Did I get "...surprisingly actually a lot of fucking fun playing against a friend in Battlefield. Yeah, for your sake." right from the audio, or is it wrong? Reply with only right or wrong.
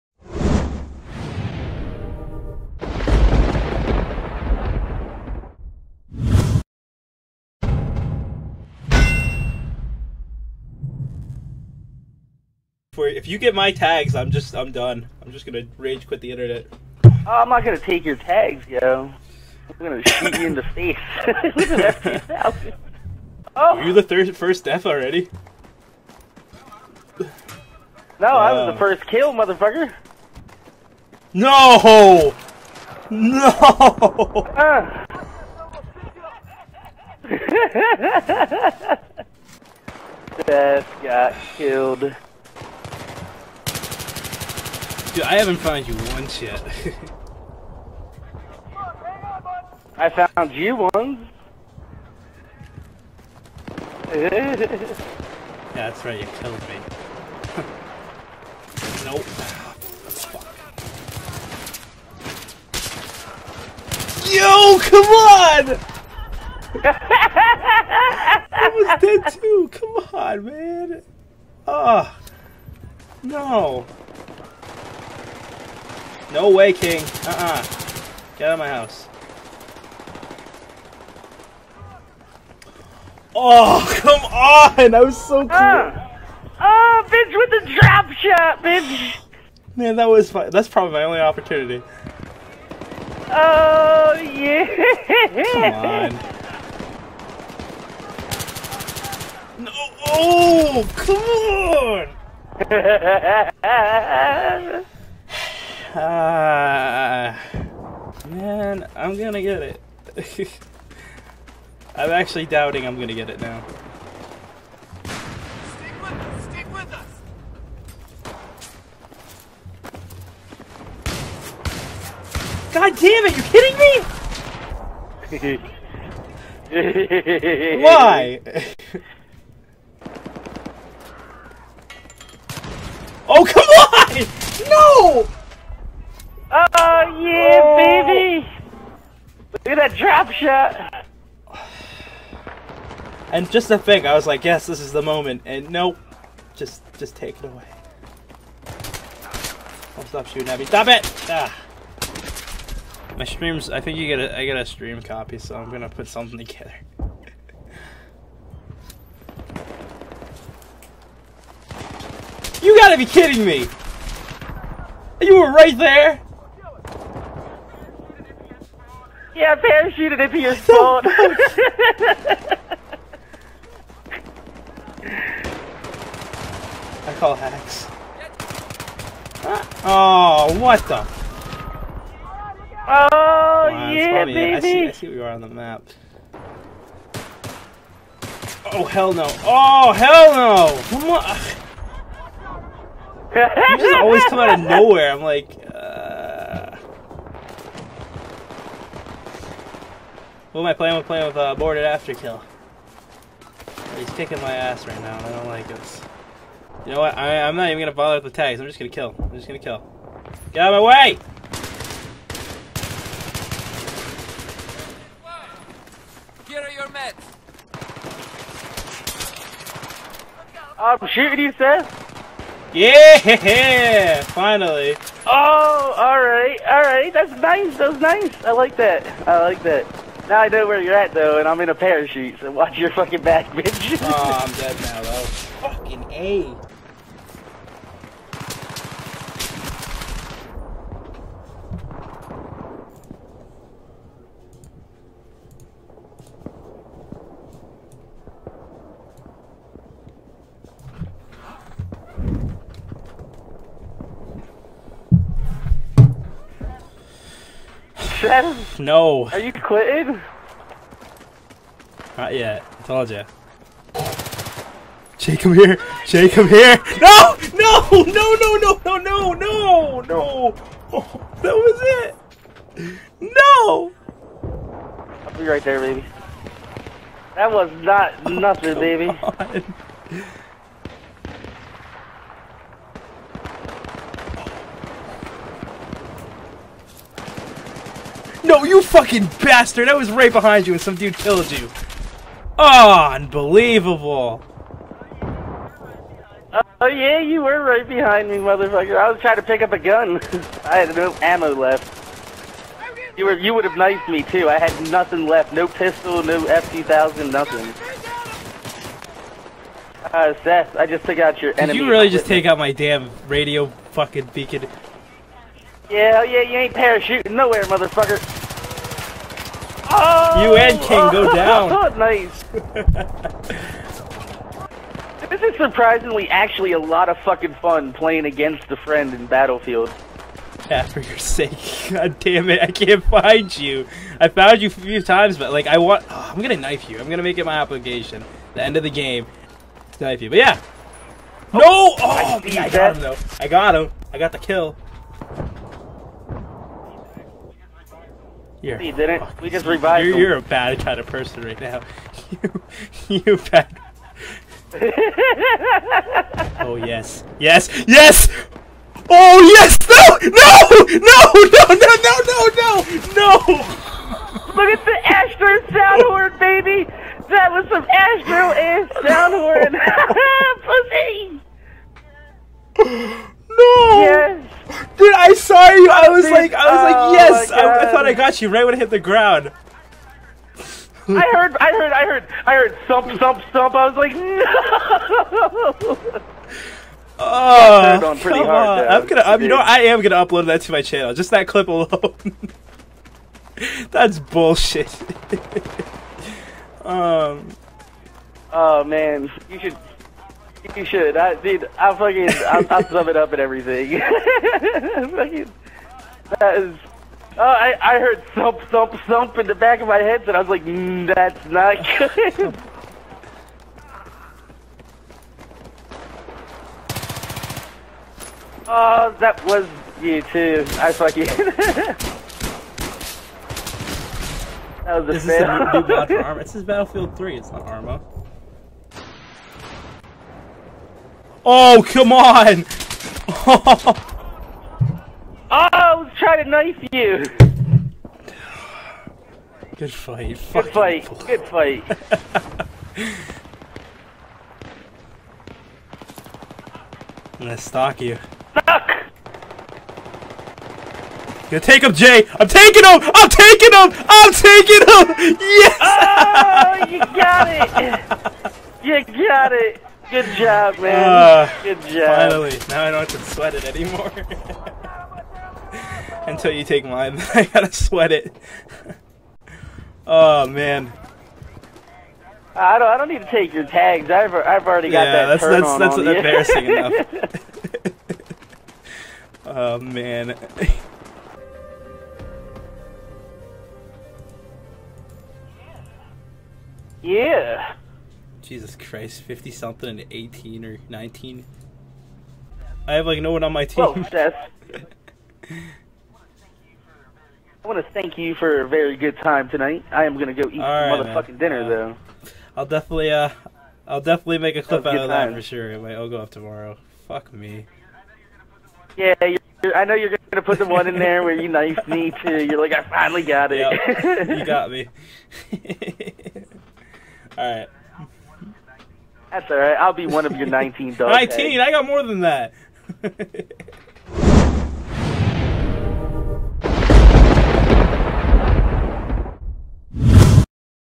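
right.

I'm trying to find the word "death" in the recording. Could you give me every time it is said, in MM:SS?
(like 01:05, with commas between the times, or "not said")
00:24, 00:40.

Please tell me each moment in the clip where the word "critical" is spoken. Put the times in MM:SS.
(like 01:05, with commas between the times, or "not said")
not said.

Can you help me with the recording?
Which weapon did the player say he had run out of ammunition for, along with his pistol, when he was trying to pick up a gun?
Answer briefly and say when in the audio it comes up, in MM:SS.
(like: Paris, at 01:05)
F2000, at 05:06.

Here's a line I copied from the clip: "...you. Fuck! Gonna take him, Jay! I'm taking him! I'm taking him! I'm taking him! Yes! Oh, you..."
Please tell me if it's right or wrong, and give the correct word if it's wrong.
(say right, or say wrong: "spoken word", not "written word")
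right.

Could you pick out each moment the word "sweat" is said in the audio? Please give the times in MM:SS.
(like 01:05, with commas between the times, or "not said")
07:43, 07:47.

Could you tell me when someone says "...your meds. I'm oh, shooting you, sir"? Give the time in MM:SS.
03:36.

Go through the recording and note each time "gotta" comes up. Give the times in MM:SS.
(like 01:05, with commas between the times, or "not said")
02:42, 07:47.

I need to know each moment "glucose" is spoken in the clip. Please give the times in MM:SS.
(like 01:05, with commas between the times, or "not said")
not said.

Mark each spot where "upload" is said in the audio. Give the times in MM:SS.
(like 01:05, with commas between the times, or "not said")
06:30.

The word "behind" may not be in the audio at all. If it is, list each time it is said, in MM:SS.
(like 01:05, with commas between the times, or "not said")
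04:50, 04:57.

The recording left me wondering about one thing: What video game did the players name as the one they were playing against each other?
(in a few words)
Battlefield 3.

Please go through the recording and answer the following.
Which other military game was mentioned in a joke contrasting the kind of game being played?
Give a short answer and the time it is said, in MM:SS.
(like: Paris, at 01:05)
Arma, at 07:07.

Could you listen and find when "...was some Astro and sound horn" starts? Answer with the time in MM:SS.
06:07.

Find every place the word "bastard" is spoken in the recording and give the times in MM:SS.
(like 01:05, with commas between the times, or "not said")
04:49.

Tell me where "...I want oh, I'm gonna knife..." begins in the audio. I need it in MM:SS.
05:35.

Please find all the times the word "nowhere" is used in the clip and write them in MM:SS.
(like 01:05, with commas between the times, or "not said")
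03:14, 05:17.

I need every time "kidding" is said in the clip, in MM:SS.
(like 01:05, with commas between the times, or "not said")
02:05, 02:43.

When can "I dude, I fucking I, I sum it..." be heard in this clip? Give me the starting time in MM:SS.
06:41.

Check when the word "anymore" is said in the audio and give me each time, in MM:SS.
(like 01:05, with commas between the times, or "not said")
07:43.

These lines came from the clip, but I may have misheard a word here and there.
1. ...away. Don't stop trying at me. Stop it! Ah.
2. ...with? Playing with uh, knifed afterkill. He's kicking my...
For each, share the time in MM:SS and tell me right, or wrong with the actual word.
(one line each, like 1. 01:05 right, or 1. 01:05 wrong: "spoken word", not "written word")
1. 02:27 wrong: "shooting", not "trying"
2. 03:20 wrong: "boarded", not "knifed".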